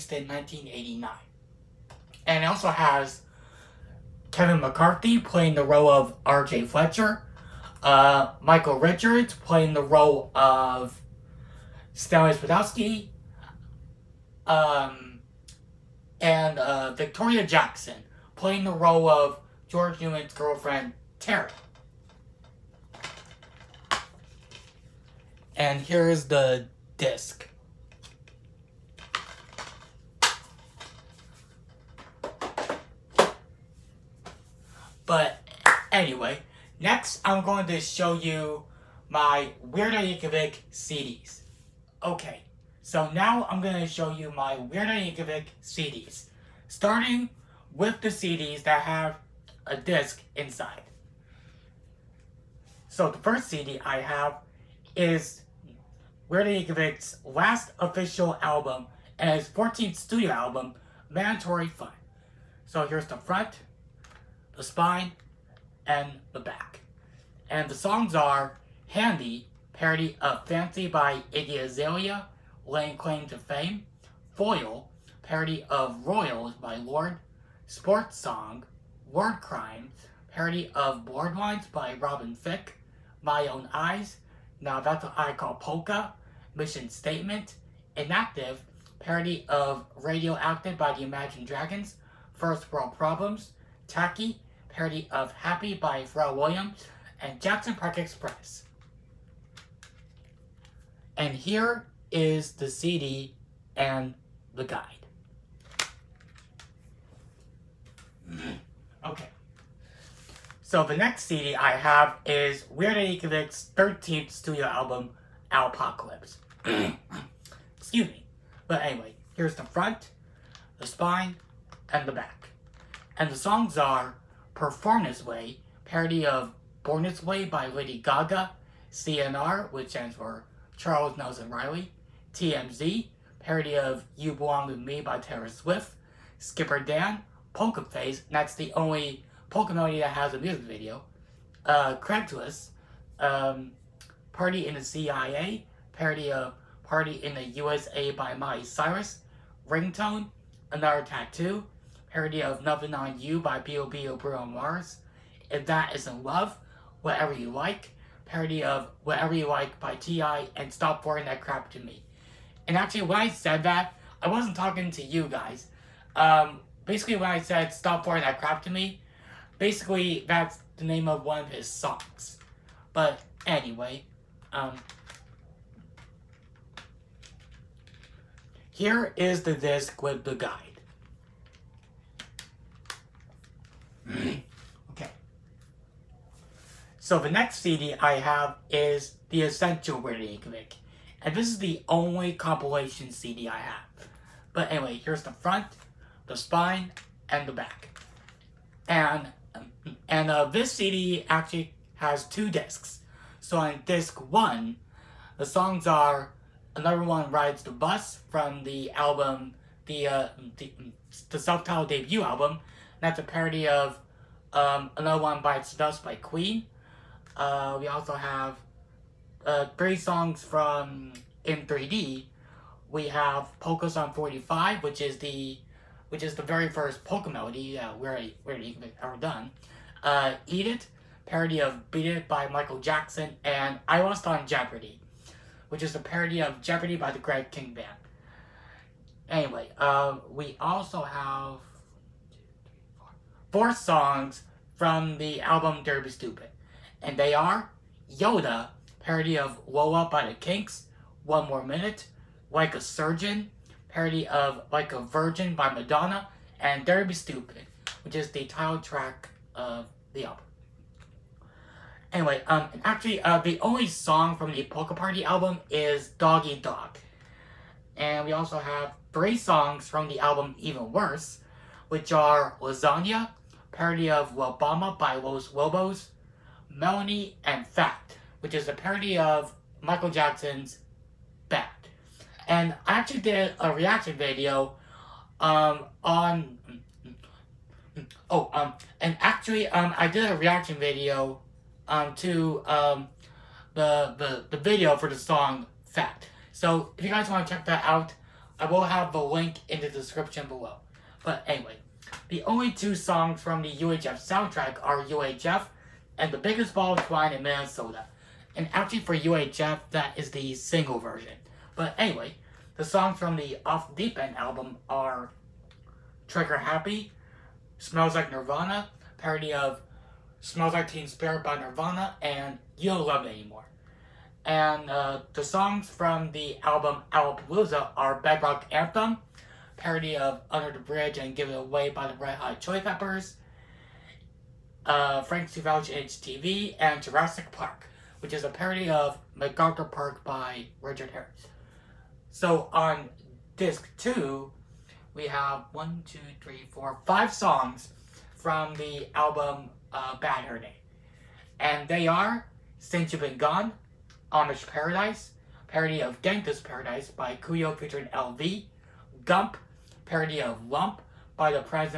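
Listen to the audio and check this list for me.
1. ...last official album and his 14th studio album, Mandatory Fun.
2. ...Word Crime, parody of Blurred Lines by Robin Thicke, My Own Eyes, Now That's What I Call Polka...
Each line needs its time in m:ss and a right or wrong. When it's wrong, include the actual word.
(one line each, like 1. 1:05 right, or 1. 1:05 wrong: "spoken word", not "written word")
1. 0:57 right
2. 1:19 right.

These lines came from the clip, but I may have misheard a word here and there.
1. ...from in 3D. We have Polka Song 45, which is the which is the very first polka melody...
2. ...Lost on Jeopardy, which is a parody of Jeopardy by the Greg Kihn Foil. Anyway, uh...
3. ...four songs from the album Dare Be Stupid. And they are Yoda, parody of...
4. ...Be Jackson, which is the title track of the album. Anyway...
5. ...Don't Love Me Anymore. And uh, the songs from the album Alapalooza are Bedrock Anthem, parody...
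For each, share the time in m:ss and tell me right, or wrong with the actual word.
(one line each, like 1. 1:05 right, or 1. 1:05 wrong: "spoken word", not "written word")
1. 3:40 right
2. 3:54 wrong: "Band", not "Foil"
3. 4:03 right
4. 4:17 wrong: "Stupid", not "Jackson"
5. 5:22 right.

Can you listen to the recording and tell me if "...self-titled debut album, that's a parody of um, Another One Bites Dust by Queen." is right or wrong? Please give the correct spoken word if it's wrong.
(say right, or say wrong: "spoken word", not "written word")
right.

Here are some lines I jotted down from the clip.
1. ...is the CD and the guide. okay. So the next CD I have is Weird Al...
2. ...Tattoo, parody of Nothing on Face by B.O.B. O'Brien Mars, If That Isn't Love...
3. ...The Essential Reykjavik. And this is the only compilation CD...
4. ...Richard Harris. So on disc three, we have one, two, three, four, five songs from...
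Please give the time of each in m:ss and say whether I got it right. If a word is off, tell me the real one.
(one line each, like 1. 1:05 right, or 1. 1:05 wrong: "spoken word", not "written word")
1. 1:42 right
2. 2:31 wrong: "You", not "Face"
3. 3:09 right
4. 5:40 wrong: "two", not "three".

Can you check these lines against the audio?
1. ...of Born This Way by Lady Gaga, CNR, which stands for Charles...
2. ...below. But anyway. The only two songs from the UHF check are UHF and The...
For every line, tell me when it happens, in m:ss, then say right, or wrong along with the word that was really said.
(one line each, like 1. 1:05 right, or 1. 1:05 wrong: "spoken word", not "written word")
1. 2:06 right
2. 5:00 wrong: "soundtrack", not "check".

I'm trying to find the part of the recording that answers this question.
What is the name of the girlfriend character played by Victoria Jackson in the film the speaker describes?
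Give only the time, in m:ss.
0:21.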